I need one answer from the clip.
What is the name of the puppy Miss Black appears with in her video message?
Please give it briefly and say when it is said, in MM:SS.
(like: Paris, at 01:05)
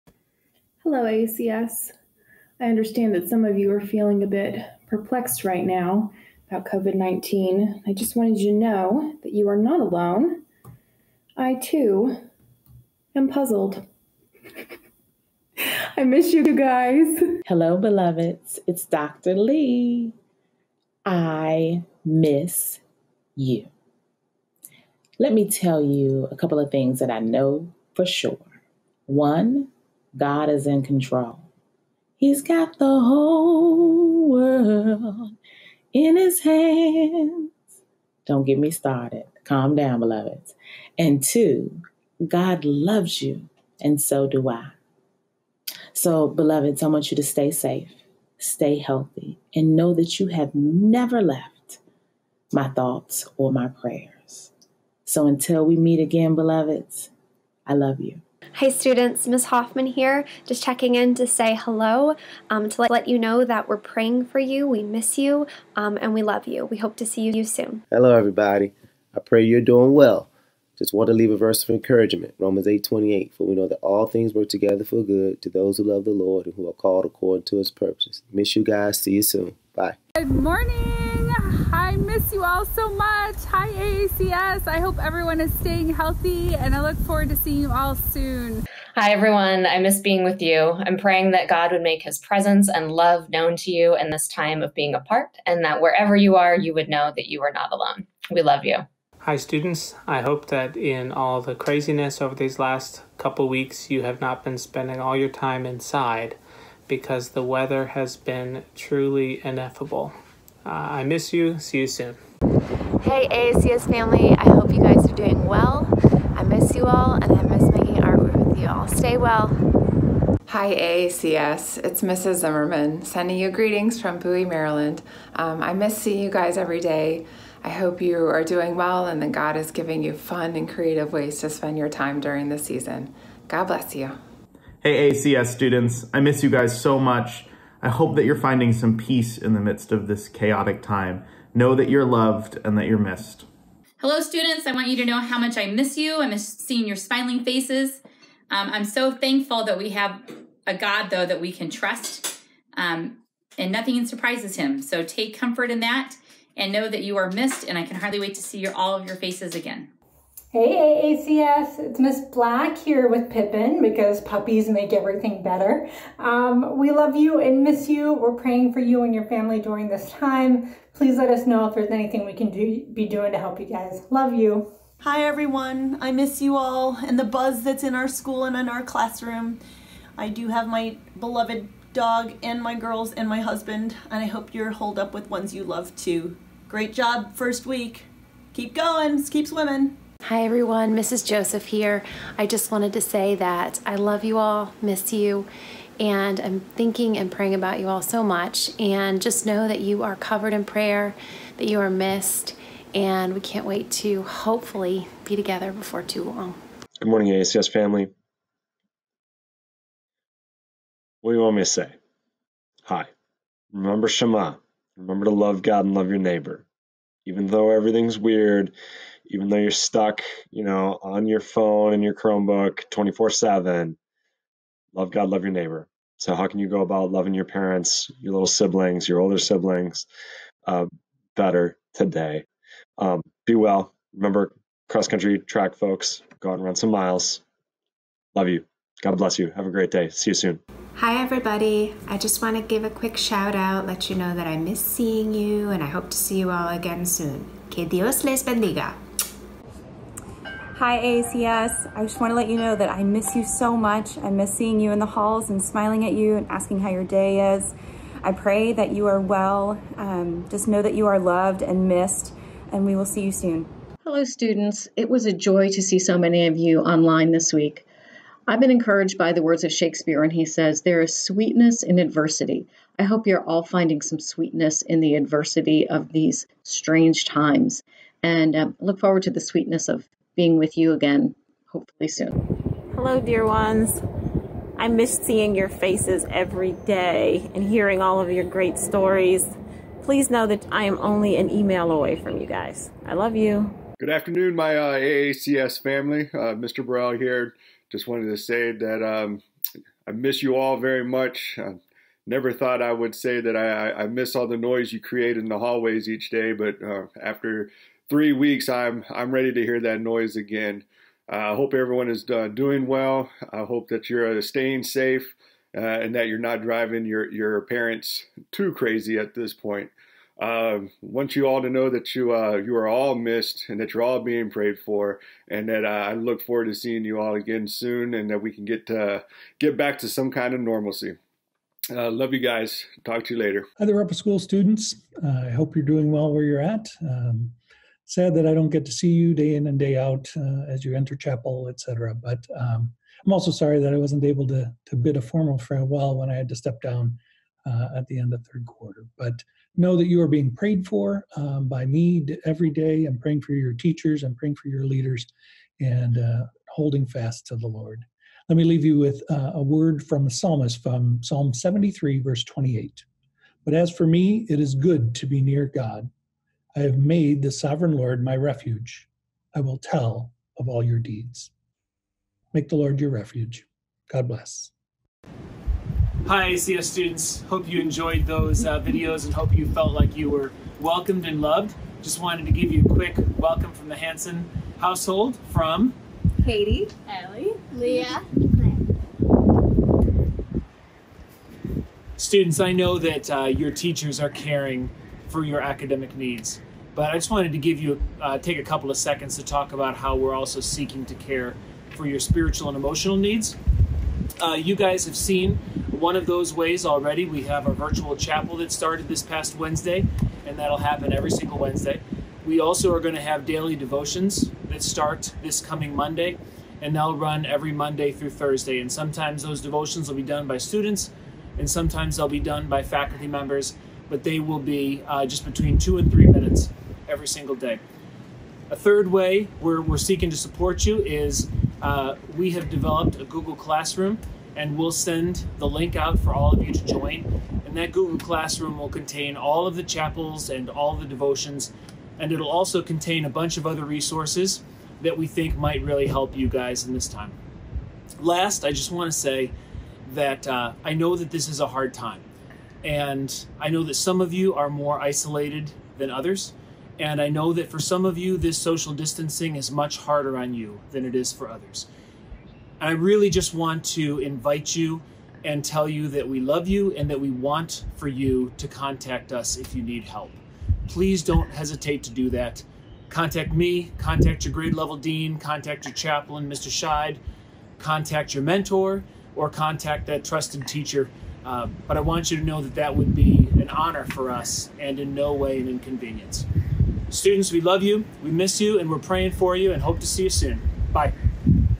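Pippin, at 02:43.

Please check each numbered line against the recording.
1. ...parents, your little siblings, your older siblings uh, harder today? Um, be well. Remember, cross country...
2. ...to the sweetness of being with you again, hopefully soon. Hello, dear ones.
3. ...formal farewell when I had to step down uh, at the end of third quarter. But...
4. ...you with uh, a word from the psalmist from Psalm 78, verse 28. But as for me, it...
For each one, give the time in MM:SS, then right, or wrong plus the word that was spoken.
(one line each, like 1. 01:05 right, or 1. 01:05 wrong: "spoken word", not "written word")
1. 03:47 wrong: "better", not "harder"
2. 04:39 right
3. 05:45 right
4. 05:58 wrong: "73", not "78".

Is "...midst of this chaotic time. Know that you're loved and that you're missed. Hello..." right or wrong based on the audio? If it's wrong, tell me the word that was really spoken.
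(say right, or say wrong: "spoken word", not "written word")
right.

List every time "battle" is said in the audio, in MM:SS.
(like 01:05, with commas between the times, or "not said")
not said.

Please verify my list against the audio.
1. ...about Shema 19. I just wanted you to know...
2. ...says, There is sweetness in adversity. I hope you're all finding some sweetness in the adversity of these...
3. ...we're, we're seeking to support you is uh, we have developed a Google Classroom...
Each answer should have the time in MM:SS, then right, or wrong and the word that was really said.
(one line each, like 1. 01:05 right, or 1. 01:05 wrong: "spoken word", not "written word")
1. 00:06 wrong: "COVID", not "Shema"
2. 04:30 right
3. 07:09 right.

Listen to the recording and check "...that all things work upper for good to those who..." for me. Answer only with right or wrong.
wrong.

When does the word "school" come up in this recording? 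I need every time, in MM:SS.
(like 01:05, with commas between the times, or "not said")
02:58, 05:34.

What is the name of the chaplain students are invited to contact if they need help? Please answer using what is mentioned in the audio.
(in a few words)
Mr. Scheid.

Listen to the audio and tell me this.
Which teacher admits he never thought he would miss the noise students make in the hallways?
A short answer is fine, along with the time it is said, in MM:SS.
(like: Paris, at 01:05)
Mr. Burrell, at 04:56.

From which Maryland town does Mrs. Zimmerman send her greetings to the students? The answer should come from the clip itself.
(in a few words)
Bowie.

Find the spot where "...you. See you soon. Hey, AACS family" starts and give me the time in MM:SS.
01:51.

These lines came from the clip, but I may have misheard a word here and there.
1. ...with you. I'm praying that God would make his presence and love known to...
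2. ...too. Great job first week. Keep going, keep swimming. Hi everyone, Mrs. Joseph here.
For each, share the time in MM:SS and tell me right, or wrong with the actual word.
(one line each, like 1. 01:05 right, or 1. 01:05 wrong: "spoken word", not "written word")
1. 01:30 right
2. 03:05 right.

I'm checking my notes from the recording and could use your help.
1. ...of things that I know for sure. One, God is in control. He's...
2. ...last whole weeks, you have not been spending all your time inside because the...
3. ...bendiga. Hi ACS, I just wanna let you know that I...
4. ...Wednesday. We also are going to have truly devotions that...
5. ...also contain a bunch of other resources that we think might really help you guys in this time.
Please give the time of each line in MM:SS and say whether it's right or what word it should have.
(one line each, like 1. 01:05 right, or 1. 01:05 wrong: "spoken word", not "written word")
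1. 00:26 right
2. 01:42 wrong: "couple", not "whole"
3. 04:08 right
4. 06:51 wrong: "daily", not "truly"
5. 07:22 right.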